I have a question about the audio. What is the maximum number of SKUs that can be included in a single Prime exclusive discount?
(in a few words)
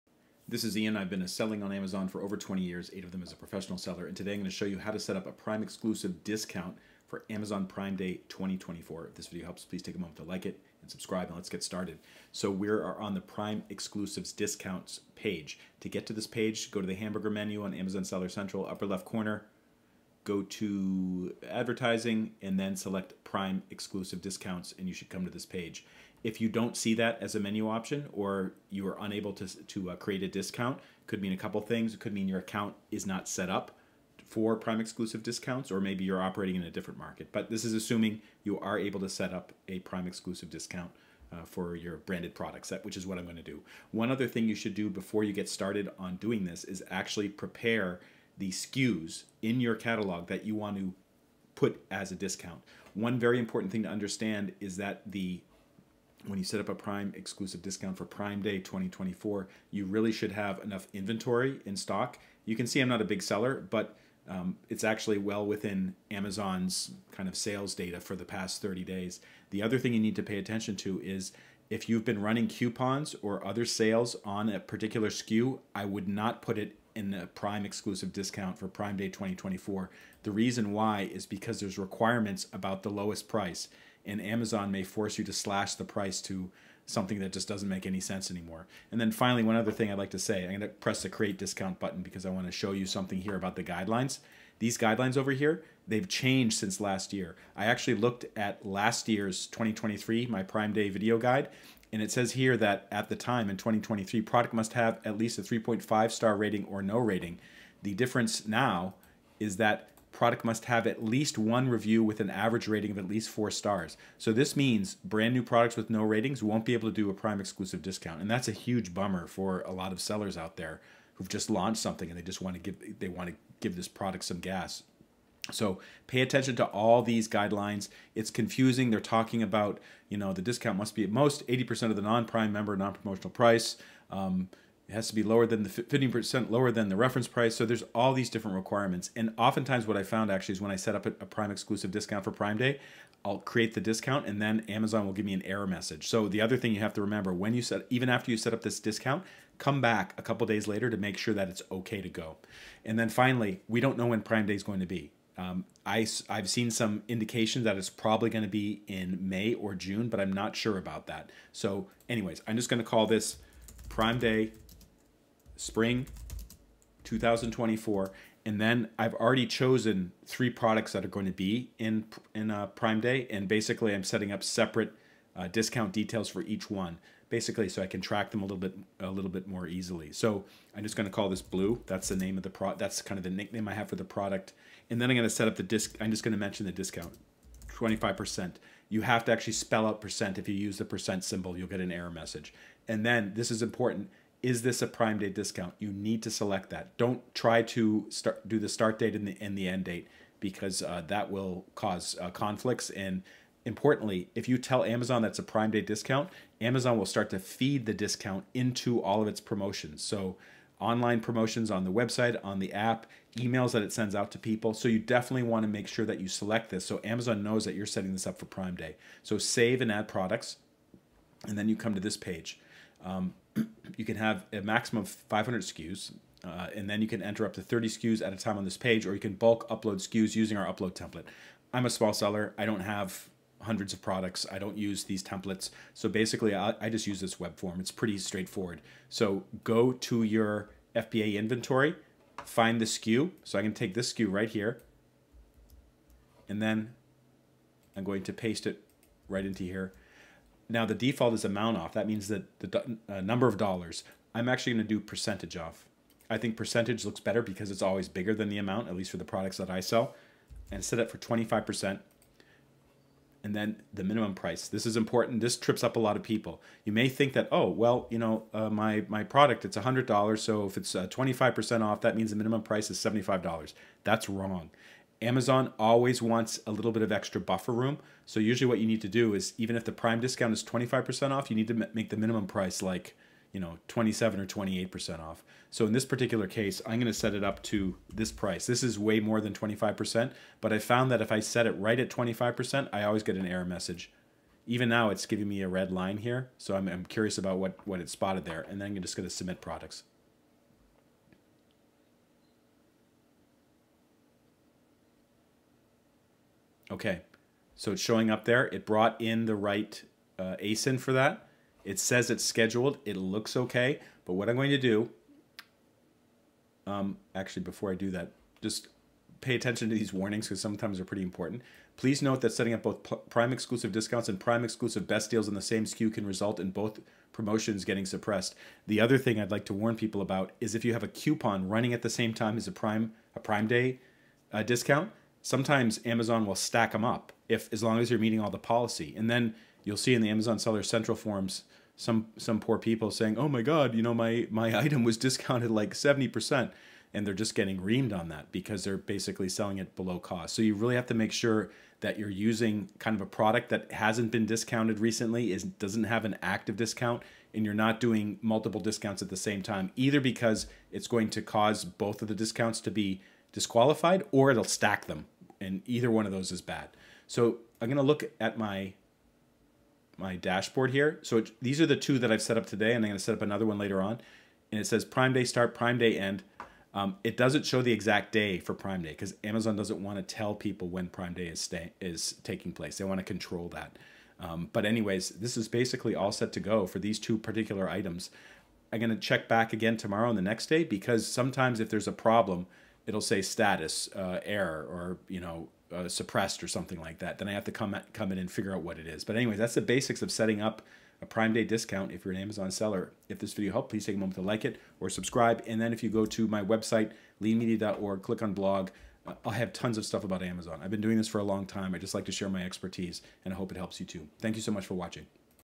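500.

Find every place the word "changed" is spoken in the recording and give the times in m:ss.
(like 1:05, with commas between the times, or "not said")
1:36.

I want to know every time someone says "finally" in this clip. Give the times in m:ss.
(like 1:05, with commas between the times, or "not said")
1:29, 2:33.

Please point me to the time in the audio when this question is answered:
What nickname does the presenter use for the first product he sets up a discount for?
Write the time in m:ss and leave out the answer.
3:01.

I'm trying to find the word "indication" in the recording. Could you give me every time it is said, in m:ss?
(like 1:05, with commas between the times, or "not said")
2:37.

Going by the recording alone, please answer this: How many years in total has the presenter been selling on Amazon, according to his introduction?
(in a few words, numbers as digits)
over 20 years.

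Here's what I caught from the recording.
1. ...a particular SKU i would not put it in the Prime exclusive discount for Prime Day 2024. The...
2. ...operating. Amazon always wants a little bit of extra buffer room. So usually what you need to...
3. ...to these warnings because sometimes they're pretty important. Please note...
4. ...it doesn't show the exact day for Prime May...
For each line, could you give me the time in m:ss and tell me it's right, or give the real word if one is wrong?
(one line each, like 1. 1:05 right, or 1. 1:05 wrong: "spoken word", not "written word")
1. 1:14 right
2. 4:34 wrong: "wrong", not "operating"
3. 5:19 right
4. 6:17 wrong: "Day", not "May".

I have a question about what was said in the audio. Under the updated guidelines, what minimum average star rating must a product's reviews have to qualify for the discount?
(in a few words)
4 stars.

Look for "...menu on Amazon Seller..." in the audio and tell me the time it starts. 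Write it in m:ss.
0:17.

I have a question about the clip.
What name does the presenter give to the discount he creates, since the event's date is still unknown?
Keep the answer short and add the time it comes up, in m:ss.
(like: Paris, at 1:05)
Prime Day Spring 2024, at 2:43.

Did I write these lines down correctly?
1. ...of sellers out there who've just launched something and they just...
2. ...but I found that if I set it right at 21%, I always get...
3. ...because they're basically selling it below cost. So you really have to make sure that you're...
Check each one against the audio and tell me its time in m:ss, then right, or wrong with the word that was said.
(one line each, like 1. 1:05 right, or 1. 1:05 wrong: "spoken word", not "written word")
1. 1:59 right
2. 4:50 wrong: "25", not "21"
3. 5:48 right.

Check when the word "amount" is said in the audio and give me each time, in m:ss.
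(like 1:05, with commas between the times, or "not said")
4:11, 4:18.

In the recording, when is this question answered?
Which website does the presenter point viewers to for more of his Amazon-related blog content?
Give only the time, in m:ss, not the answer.
6:47.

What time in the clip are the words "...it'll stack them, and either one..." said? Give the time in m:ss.
6:04.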